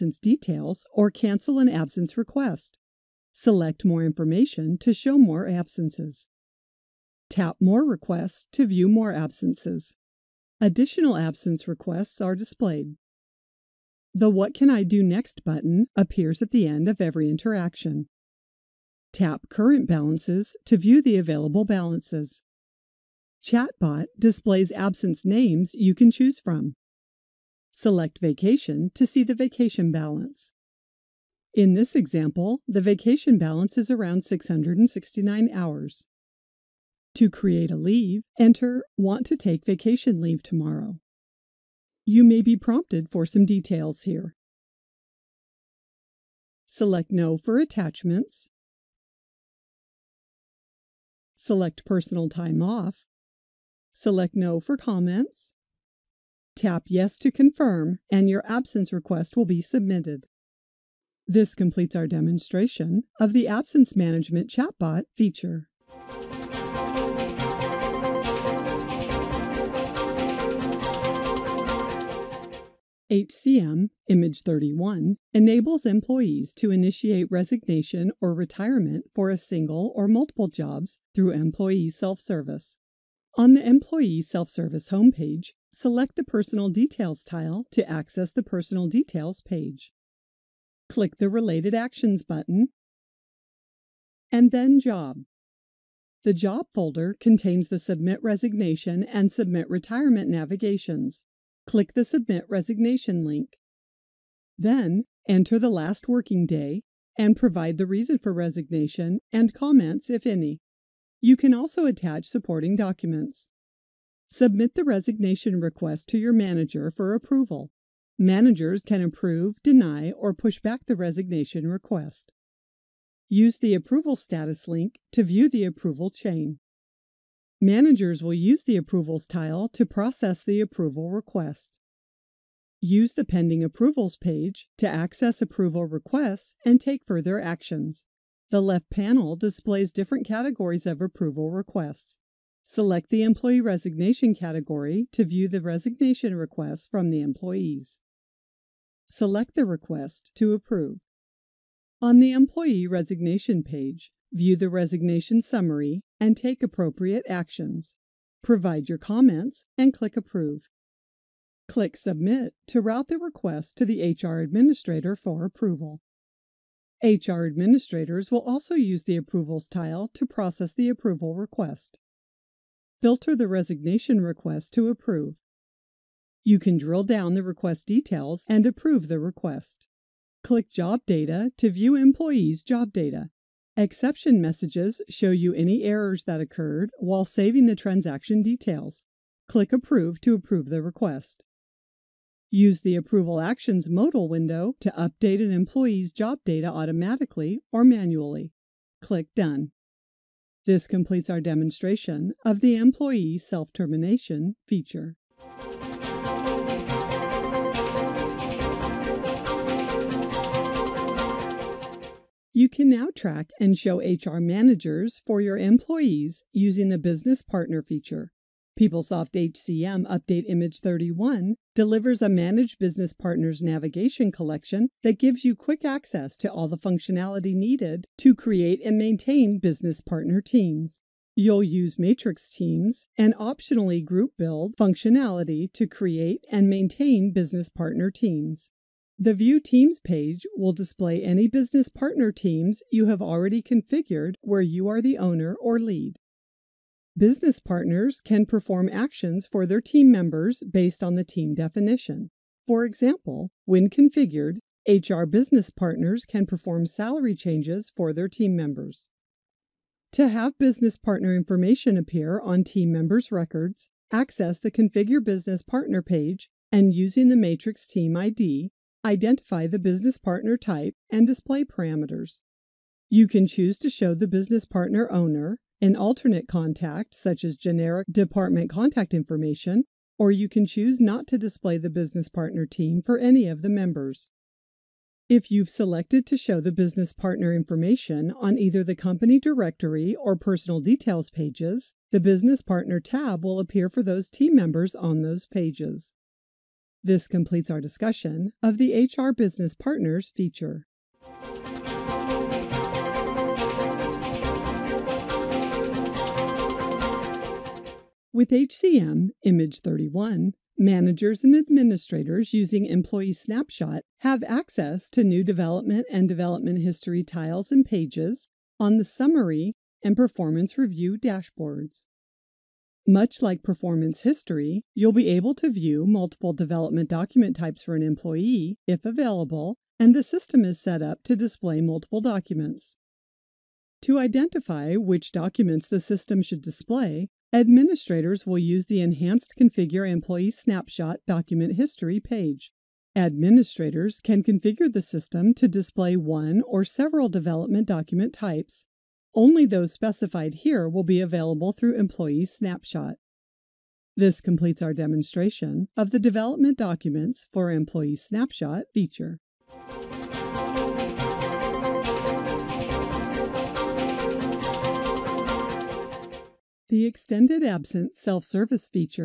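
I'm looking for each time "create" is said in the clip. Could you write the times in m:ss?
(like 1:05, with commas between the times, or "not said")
0:37, 3:48, 3:55.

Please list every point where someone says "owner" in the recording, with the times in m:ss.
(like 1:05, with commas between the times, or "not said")
4:05, 4:35.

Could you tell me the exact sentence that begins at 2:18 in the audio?
The left panel displays different categories of approval requests.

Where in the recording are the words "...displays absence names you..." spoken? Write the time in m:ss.
0:24.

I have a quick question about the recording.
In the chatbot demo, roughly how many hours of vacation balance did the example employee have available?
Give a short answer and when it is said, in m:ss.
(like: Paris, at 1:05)
669 hours, at 0:34.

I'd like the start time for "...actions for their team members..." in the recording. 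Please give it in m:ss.
4:08.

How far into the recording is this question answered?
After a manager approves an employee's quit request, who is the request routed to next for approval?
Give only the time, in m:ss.
2:44.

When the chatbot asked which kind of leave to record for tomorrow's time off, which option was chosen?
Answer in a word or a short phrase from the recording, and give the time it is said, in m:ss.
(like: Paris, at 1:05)
Personal Time Off, at 0:51.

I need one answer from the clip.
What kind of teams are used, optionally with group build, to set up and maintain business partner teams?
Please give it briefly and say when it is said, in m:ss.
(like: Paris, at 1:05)
matrix teams, at 3:51.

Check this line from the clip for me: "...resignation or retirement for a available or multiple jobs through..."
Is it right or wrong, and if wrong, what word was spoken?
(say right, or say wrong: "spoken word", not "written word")
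wrong: "single", not "available".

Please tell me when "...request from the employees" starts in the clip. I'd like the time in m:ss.
2:26.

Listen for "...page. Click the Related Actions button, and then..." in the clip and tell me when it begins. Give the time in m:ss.
1:29.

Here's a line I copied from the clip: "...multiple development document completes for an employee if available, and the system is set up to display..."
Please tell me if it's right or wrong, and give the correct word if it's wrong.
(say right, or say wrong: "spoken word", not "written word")
wrong: "types", not "completes".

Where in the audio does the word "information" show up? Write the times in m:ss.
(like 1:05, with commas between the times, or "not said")
0:04, 4:21, 4:39, 4:47.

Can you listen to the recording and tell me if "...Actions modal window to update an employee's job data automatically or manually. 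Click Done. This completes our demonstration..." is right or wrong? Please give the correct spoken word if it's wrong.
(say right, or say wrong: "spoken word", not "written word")
right.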